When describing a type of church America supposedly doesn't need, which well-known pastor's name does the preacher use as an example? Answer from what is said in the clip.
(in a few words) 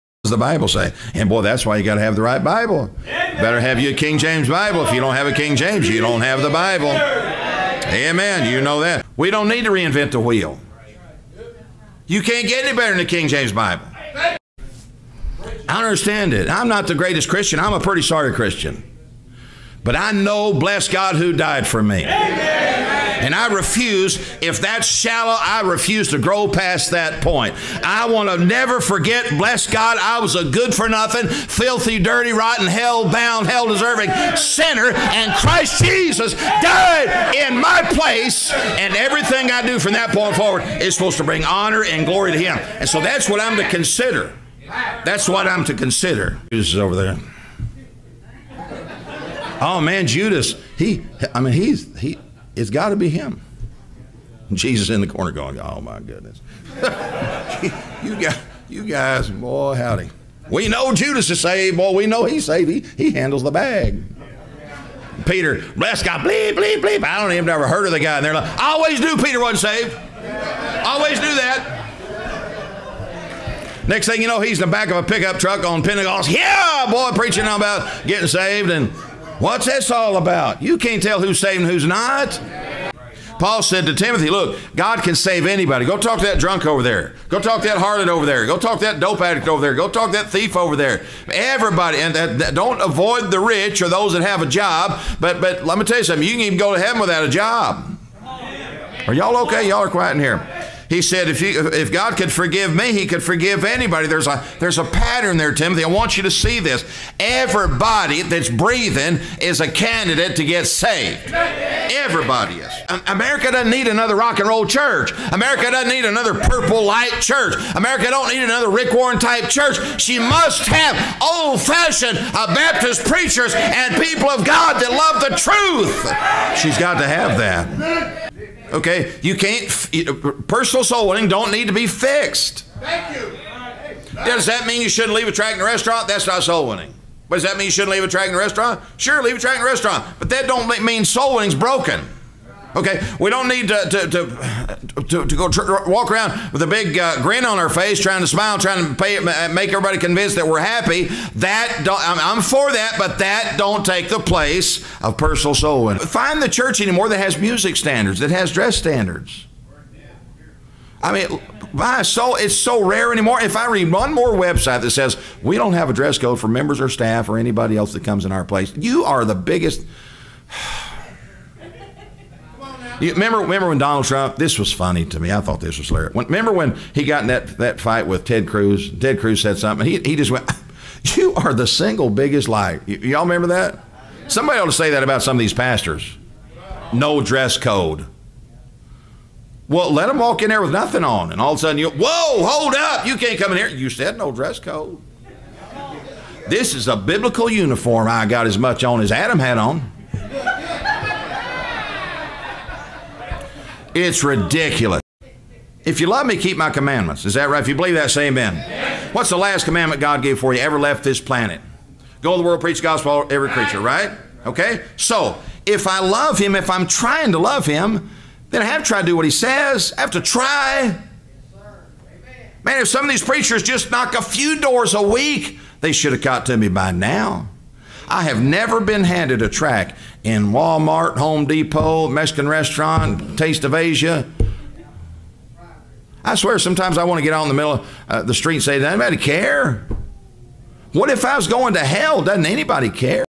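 Rick Warren.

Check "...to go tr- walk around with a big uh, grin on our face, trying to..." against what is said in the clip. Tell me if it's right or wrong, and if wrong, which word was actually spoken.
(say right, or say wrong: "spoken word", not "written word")
right.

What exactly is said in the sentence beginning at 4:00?
What if I was going to hell?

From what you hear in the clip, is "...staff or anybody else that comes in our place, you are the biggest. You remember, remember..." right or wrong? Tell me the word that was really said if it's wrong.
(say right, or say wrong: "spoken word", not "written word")
right.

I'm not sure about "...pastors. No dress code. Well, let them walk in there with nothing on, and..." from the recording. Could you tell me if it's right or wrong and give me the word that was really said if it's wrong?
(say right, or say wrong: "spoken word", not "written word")
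right.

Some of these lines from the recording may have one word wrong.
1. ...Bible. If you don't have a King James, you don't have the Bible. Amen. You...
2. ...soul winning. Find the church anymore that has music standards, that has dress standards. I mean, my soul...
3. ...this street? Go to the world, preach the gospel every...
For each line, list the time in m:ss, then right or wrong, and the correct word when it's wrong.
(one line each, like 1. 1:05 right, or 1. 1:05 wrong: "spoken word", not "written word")
1. 0:04 right
2. 2:35 right
3. 3:31 wrong: "planet", not "street".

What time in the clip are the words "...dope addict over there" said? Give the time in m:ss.
1:28.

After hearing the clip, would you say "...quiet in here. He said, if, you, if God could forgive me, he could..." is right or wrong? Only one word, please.
right.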